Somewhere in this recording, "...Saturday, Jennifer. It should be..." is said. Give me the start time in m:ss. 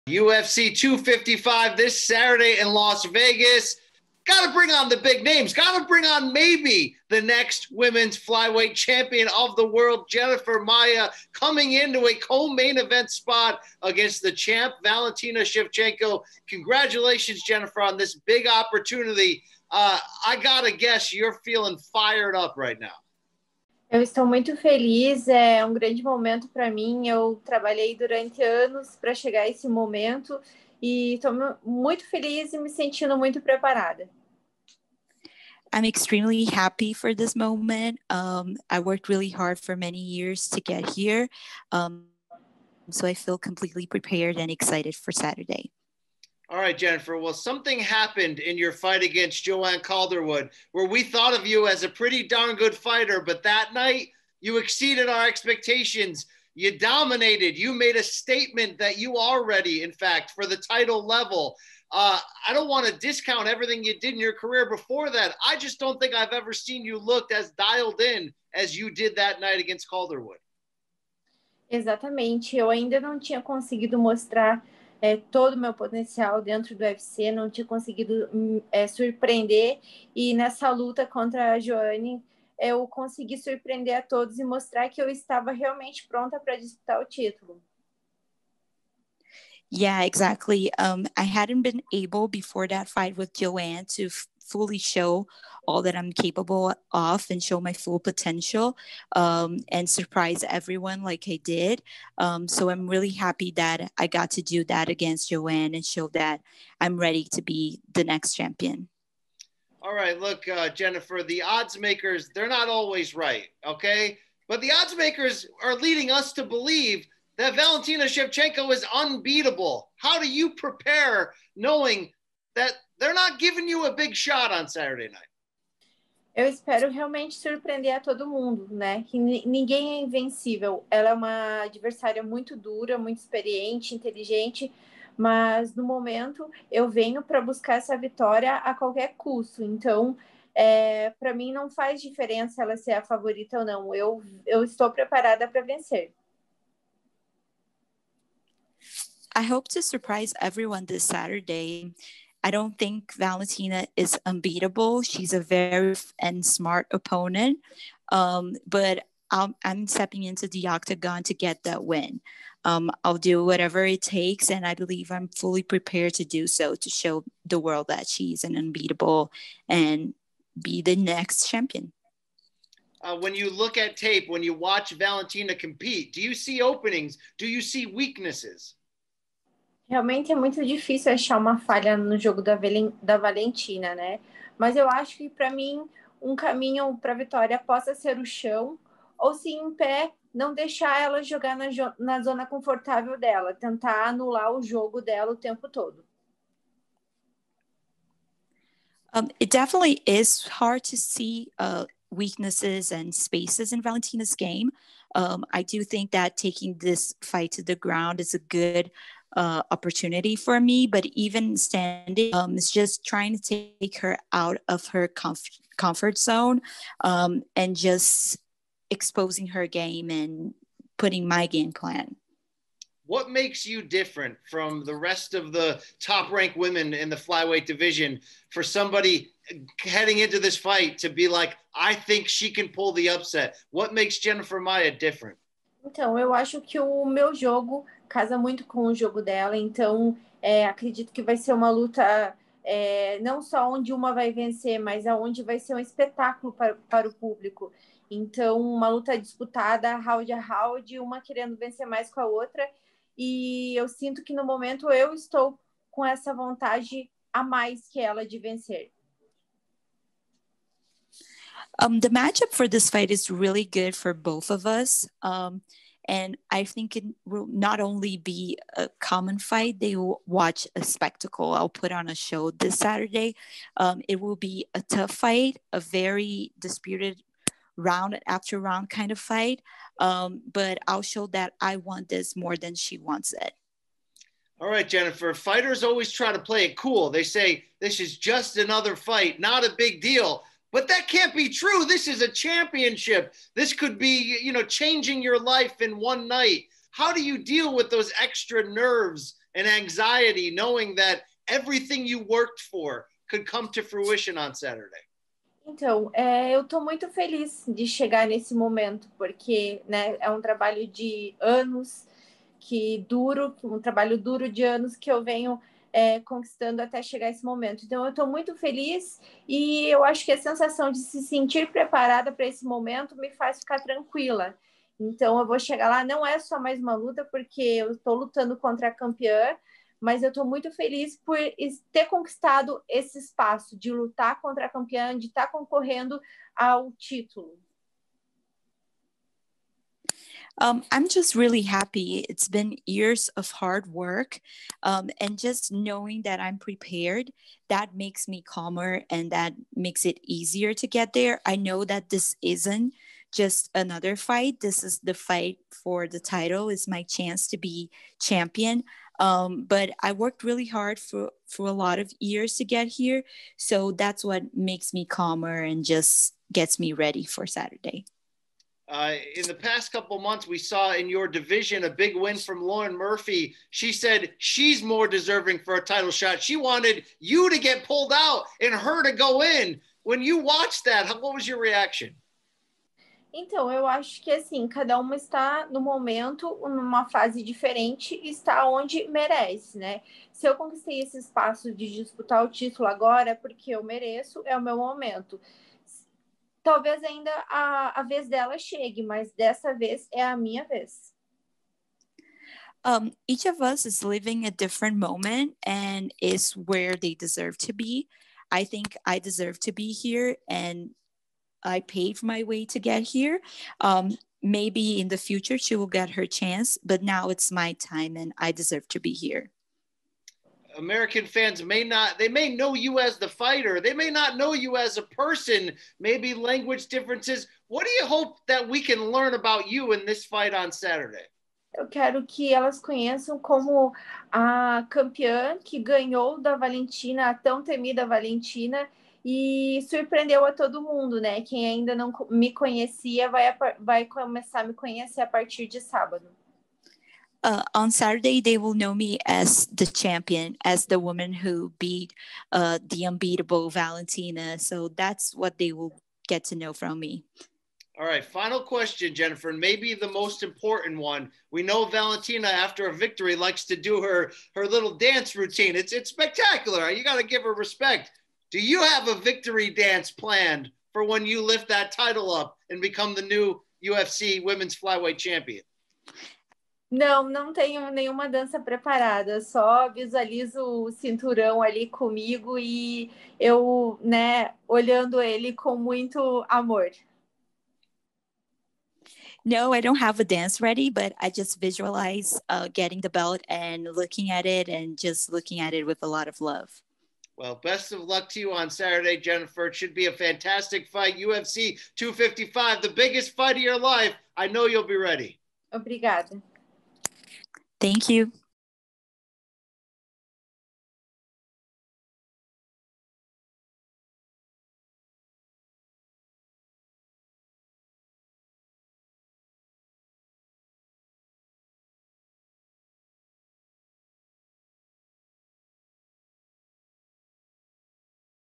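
8:18.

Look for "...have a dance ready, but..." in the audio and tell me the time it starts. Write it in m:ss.
8:10.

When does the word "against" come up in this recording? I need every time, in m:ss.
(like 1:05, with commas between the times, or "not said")
0:13, 0:49, 1:09, 1:44.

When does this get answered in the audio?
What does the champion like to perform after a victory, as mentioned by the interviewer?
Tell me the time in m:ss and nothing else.
7:44.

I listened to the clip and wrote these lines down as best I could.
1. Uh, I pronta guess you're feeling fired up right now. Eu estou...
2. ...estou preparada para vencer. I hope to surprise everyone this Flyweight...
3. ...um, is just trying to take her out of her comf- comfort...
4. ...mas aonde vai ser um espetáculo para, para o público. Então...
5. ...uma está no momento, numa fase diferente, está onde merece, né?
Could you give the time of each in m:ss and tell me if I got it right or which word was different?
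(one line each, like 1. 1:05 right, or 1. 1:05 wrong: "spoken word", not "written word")
1. 0:19 wrong: "gotta", not "pronta"
2. 2:24 wrong: "Saturday", not "Flyweight"
3. 3:32 right
4. 4:04 right
5. 6:24 right.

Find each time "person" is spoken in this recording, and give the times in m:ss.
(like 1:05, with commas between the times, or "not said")
7:05.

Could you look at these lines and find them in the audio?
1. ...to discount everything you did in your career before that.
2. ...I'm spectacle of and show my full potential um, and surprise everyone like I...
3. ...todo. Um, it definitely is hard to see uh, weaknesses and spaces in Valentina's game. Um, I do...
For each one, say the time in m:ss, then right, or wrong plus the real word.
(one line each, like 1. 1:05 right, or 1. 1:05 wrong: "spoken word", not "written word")
1. 1:02 right
2. 1:35 wrong: "capable", not "spectacle"
3. 3:15 right.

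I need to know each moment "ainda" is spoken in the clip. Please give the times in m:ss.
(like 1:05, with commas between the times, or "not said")
1:12, 6:37, 7:21.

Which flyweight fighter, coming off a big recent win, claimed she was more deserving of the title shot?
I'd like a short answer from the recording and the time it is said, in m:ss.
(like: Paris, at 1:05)
Lauren Murphy, at 6:12.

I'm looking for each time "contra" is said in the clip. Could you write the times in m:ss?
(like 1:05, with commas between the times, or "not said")
1:21, 5:28, 5:34.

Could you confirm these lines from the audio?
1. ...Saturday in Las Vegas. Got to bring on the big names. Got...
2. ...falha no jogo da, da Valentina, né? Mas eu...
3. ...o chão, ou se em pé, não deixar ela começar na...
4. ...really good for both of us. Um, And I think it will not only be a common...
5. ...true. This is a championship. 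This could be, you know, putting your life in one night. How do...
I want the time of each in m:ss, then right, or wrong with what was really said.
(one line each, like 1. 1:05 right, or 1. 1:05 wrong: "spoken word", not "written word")
1. 0:02 right
2. 3:01 right
3. 3:08 wrong: "jogar", not "começar"
4. 4:23 right
5. 4:51 wrong: "changing", not "putting".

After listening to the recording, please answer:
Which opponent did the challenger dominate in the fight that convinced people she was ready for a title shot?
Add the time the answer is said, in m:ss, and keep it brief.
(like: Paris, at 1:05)
Joanne Calderwood, at 0:49.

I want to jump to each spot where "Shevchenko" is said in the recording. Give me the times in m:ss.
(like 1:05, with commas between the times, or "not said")
0:15, 1:58.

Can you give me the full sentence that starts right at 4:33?
Um, it will be a tough fight, a very disputed round after round kind of fight.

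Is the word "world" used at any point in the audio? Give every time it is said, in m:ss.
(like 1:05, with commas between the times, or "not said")
0:09, 2:47.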